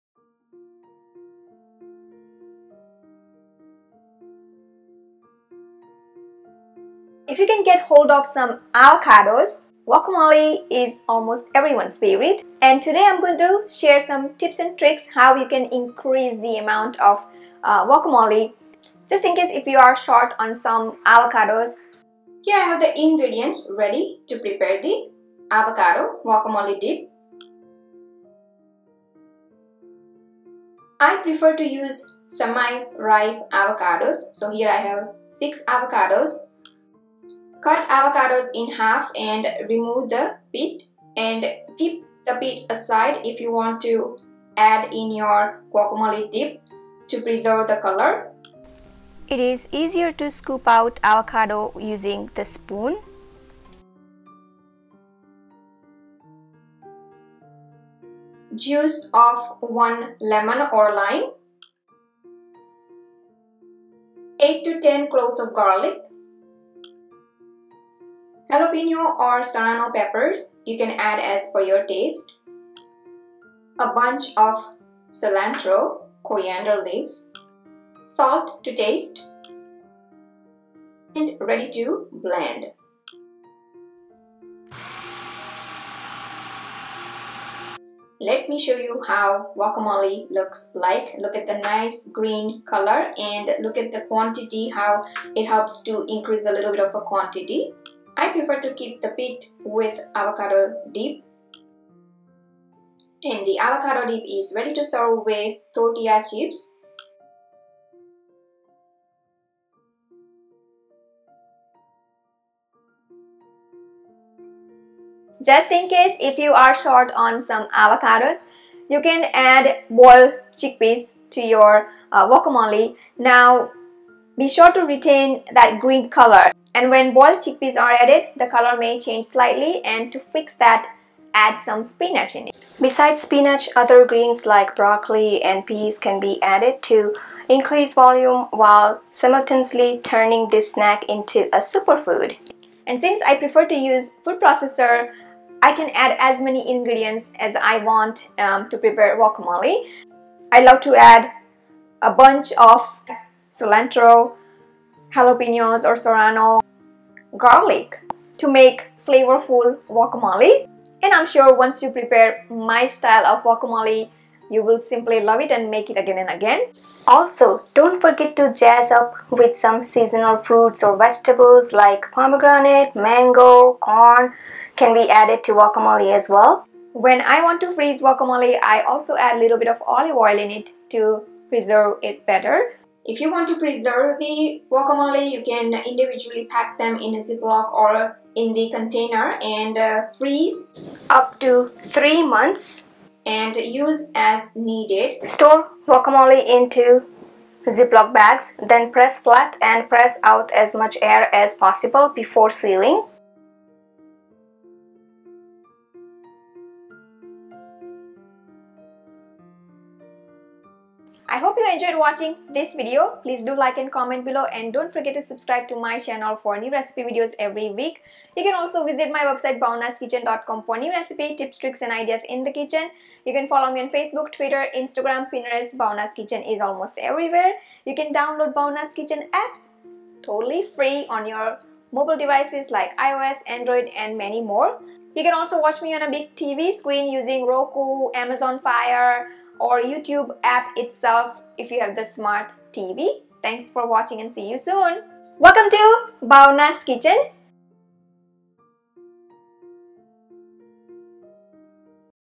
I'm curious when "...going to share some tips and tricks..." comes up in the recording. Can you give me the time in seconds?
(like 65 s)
13 s.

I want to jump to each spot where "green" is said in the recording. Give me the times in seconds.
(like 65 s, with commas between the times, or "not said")
92 s, 125 s, 134 s.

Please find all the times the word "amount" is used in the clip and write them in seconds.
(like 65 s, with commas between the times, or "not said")
16 s.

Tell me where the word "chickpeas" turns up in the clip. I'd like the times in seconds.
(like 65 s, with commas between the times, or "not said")
120 s, 127 s.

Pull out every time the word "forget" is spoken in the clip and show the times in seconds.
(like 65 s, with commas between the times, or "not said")
168 s, 214 s.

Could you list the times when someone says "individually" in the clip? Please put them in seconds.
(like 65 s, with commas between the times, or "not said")
185 s.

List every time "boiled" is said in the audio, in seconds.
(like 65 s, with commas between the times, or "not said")
119 s, 127 s.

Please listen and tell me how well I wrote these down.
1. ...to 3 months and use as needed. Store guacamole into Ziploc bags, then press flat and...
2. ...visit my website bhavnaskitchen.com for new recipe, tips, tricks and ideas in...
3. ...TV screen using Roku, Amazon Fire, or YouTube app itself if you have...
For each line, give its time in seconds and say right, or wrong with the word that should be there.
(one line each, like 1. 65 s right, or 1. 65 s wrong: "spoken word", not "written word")
1. 191 s right
2. 218 s right
3. 236 s right.